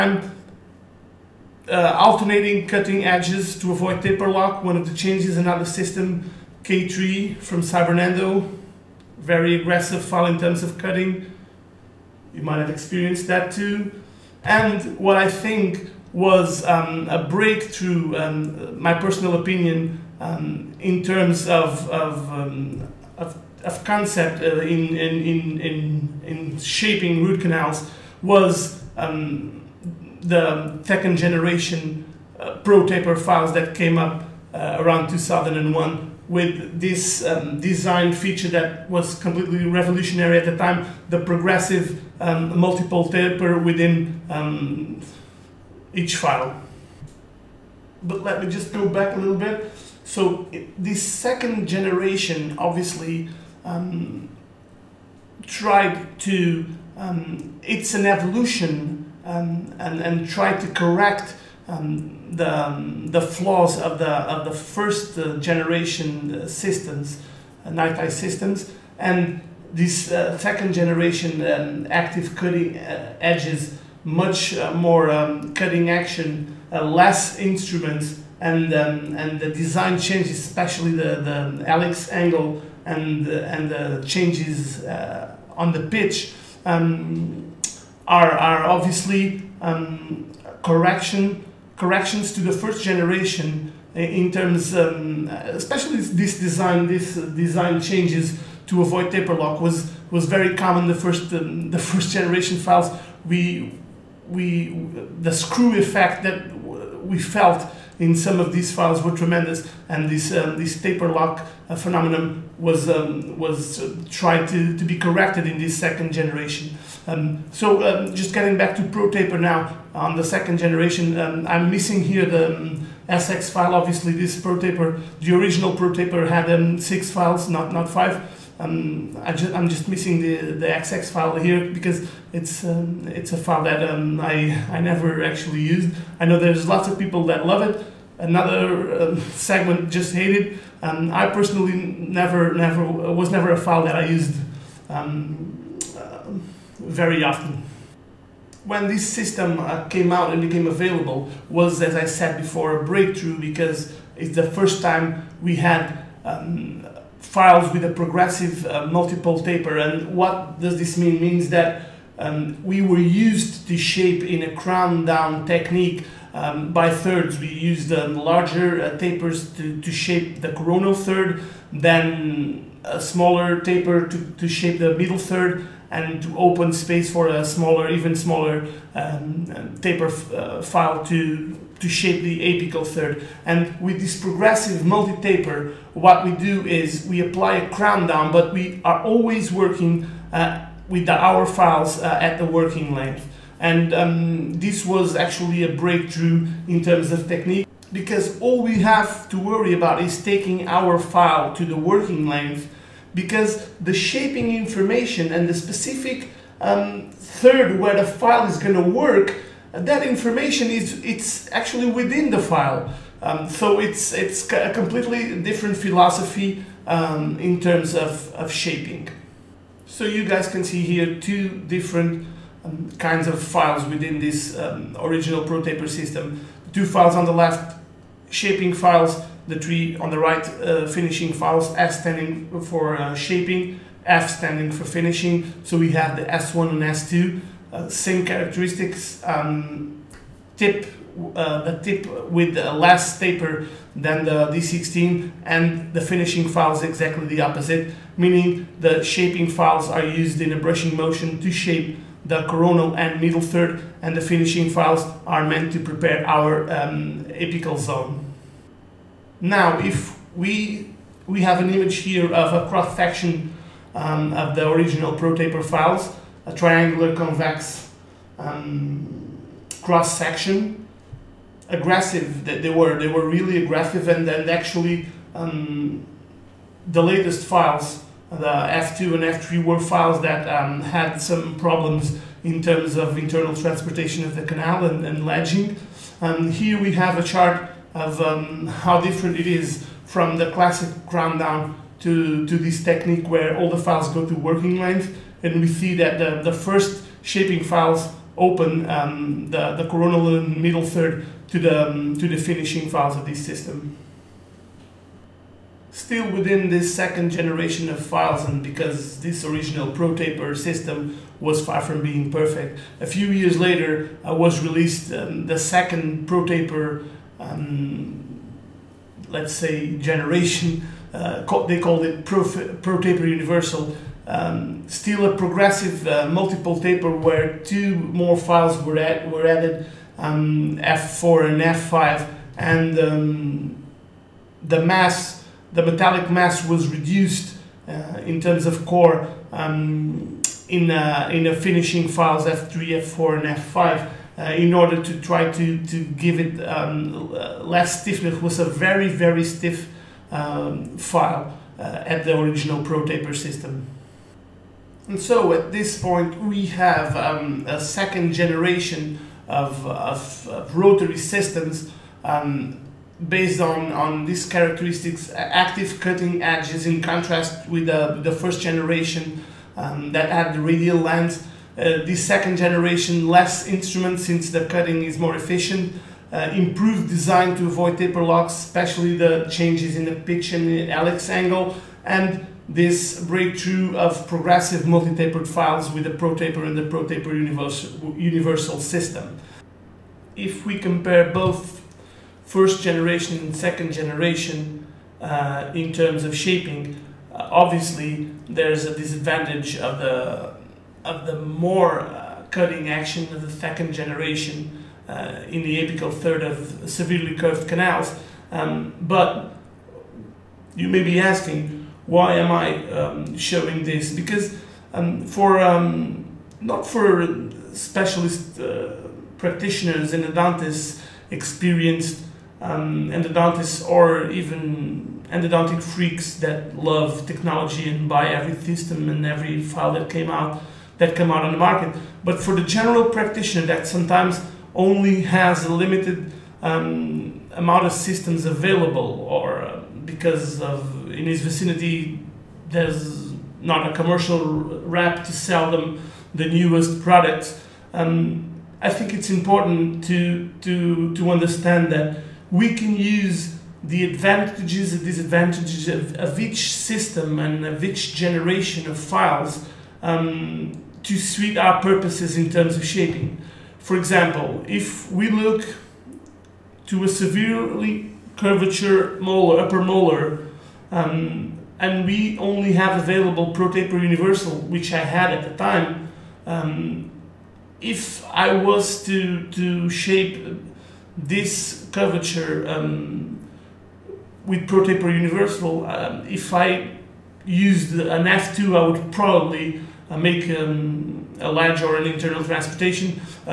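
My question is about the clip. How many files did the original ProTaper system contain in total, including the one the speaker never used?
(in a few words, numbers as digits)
6.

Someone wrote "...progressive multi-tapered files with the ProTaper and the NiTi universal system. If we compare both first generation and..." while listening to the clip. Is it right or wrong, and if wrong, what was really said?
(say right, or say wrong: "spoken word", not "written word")
wrong: "ProTaper", not "NiTi".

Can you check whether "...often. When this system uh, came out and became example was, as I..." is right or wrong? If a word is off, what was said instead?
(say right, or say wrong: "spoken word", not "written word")
wrong: "available", not "example".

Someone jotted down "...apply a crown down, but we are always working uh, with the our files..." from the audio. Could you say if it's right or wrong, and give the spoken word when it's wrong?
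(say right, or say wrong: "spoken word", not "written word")
right.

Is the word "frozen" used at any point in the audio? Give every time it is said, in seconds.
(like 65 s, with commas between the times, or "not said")
not said.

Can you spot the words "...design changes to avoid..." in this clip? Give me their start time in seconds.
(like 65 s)
97 s.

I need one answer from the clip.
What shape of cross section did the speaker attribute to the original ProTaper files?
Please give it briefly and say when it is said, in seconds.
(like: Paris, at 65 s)
triangular convex, at 266 s.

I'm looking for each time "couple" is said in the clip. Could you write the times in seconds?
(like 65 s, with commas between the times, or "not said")
not said.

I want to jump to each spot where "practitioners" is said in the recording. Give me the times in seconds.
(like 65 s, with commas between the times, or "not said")
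419 s, 433 s.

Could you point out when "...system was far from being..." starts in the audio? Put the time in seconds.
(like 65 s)
310 s.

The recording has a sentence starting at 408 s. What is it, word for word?
Um, but you may be asking, why am I um, showing this?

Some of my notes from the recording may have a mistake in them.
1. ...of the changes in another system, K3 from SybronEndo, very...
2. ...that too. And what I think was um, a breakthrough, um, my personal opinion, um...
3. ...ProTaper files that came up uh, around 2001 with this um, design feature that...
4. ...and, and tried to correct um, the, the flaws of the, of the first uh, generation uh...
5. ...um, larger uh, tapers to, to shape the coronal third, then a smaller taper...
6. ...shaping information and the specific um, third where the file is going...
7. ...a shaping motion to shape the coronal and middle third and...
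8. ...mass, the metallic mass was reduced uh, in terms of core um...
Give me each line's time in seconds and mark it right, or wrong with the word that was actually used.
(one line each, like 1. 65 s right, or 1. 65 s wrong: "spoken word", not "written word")
1. 4 s right
2. 13 s right
3. 32 s right
4. 59 s right
5. 167 s right
6. 203 s right
7. 250 s wrong: "brushing", not "shaping"
8. 334 s right.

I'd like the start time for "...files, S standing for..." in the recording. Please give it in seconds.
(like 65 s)
231 s.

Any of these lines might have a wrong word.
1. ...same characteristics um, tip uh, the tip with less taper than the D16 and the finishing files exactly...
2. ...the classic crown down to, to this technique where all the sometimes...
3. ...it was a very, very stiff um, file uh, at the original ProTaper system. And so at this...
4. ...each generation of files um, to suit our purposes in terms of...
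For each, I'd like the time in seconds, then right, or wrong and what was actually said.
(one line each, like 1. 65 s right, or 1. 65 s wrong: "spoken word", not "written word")
1. 237 s right
2. 290 s wrong: "files", not "sometimes"
3. 348 s right
4. 457 s right.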